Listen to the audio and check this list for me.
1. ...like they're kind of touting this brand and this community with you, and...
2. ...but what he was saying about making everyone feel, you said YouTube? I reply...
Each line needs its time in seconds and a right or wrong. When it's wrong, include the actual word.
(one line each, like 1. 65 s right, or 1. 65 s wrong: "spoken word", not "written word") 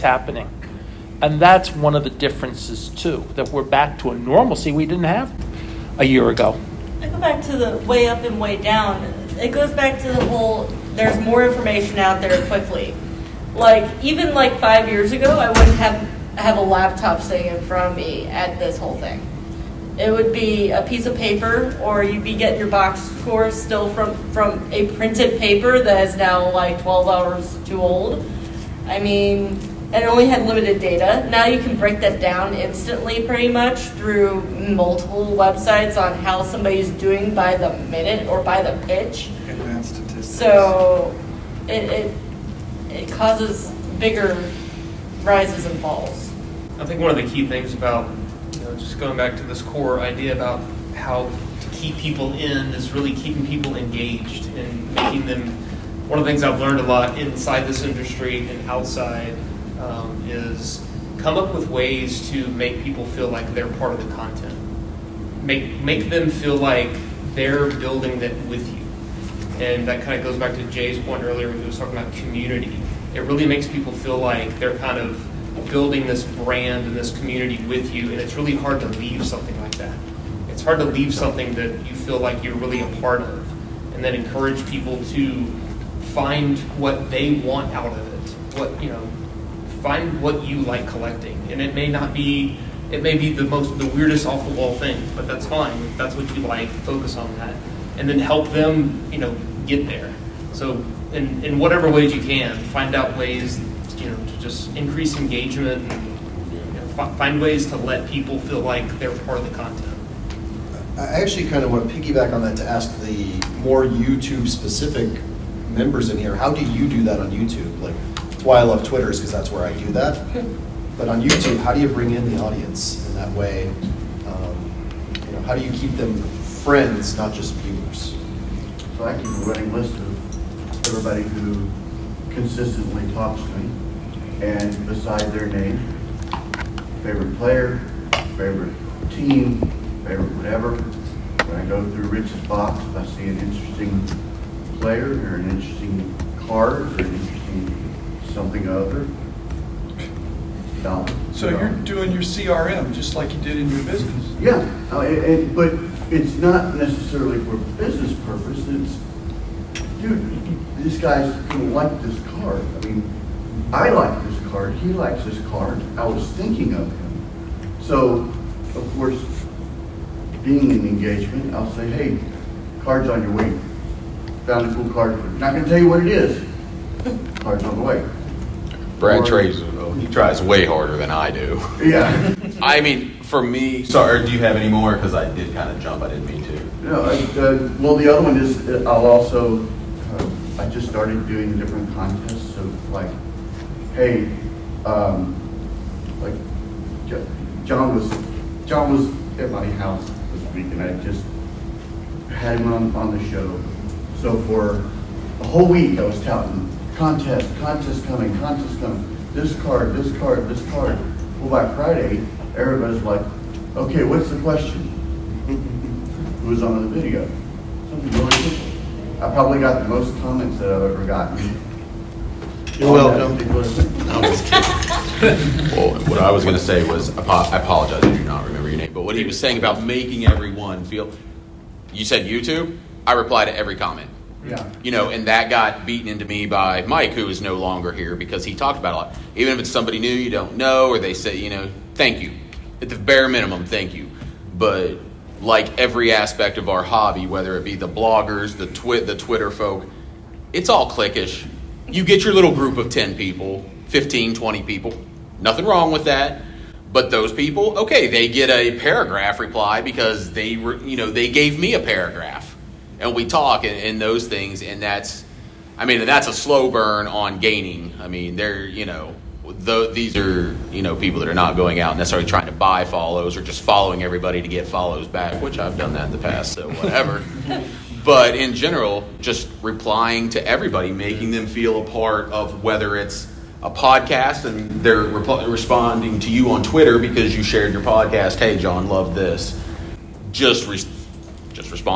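1. 74 s wrong: "building", not "touting"
2. 228 s right.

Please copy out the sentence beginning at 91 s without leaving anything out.
And it may not be, it may be the most, the weirdest off the wall thing, but that's fine.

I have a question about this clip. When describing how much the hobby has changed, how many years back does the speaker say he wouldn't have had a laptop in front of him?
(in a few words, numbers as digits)
5.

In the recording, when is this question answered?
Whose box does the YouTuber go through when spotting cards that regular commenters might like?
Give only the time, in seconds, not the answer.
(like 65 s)
142 s.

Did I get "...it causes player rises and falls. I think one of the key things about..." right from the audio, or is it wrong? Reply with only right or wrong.
wrong.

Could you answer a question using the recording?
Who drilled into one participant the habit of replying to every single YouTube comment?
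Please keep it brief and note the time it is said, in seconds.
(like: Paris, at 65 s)
Mike, at 236 s.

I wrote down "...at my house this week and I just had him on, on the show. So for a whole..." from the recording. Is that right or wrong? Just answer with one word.
right.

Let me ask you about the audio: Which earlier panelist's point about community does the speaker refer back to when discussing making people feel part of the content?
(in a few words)
Jay.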